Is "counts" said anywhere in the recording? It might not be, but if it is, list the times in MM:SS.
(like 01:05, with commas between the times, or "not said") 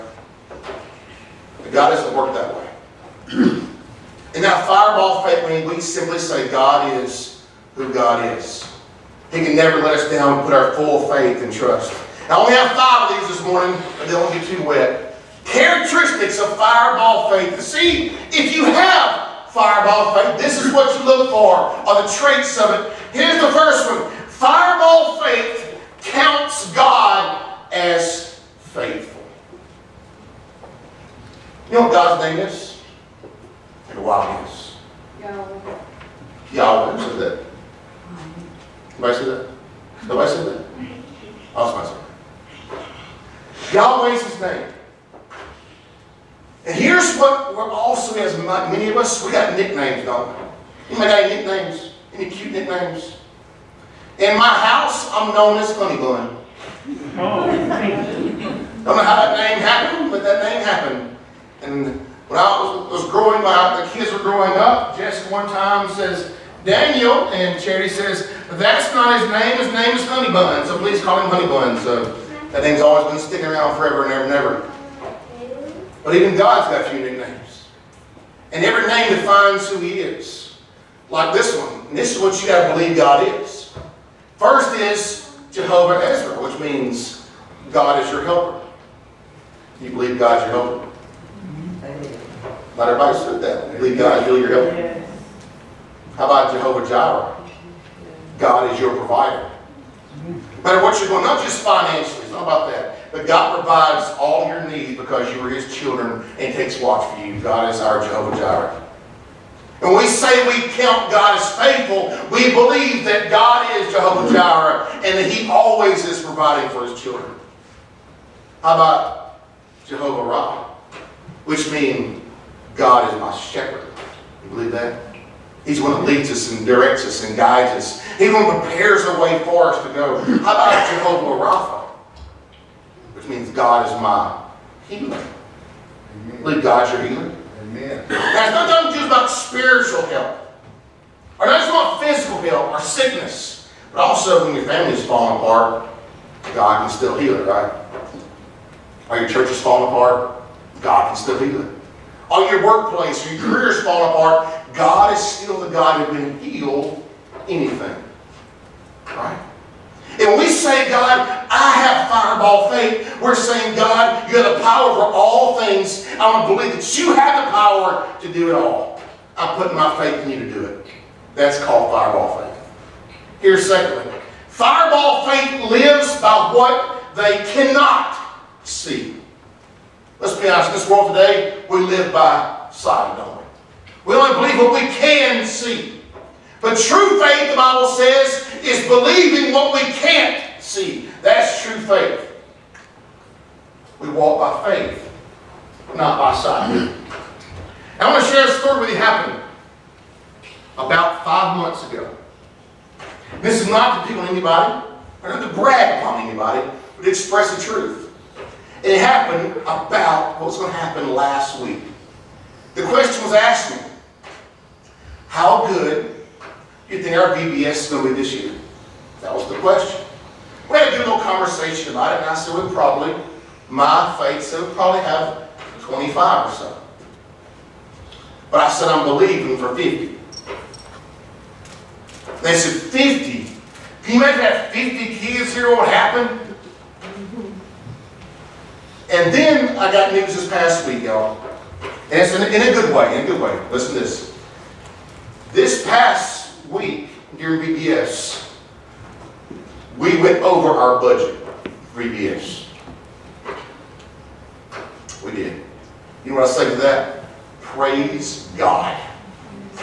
00:26, 01:50.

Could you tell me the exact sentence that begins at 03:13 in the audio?
We walk by faith, not by sight.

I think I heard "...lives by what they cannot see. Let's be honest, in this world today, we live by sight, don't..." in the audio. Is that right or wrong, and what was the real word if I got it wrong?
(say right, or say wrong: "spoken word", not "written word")
right.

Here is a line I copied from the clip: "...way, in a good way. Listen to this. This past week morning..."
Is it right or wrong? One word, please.
wrong.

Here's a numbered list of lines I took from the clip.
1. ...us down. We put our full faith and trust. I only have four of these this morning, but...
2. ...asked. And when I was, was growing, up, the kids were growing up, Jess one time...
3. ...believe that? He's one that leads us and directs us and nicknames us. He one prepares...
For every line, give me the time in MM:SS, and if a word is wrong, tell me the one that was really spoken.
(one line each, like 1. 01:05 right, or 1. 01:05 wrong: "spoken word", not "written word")
1. 00:09 wrong: "five", not "four"
2. 01:00 wrong: "happened", not "asked"
3. 02:04 wrong: "guides", not "nicknames".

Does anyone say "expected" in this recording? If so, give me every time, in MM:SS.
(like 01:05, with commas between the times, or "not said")
not said.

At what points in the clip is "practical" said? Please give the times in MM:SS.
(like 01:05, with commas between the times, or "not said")
not said.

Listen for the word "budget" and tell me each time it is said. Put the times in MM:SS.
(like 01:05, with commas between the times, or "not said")
04:10.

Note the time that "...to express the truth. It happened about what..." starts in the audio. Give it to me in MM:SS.
03:27.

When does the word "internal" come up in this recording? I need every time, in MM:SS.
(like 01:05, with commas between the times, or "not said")
not said.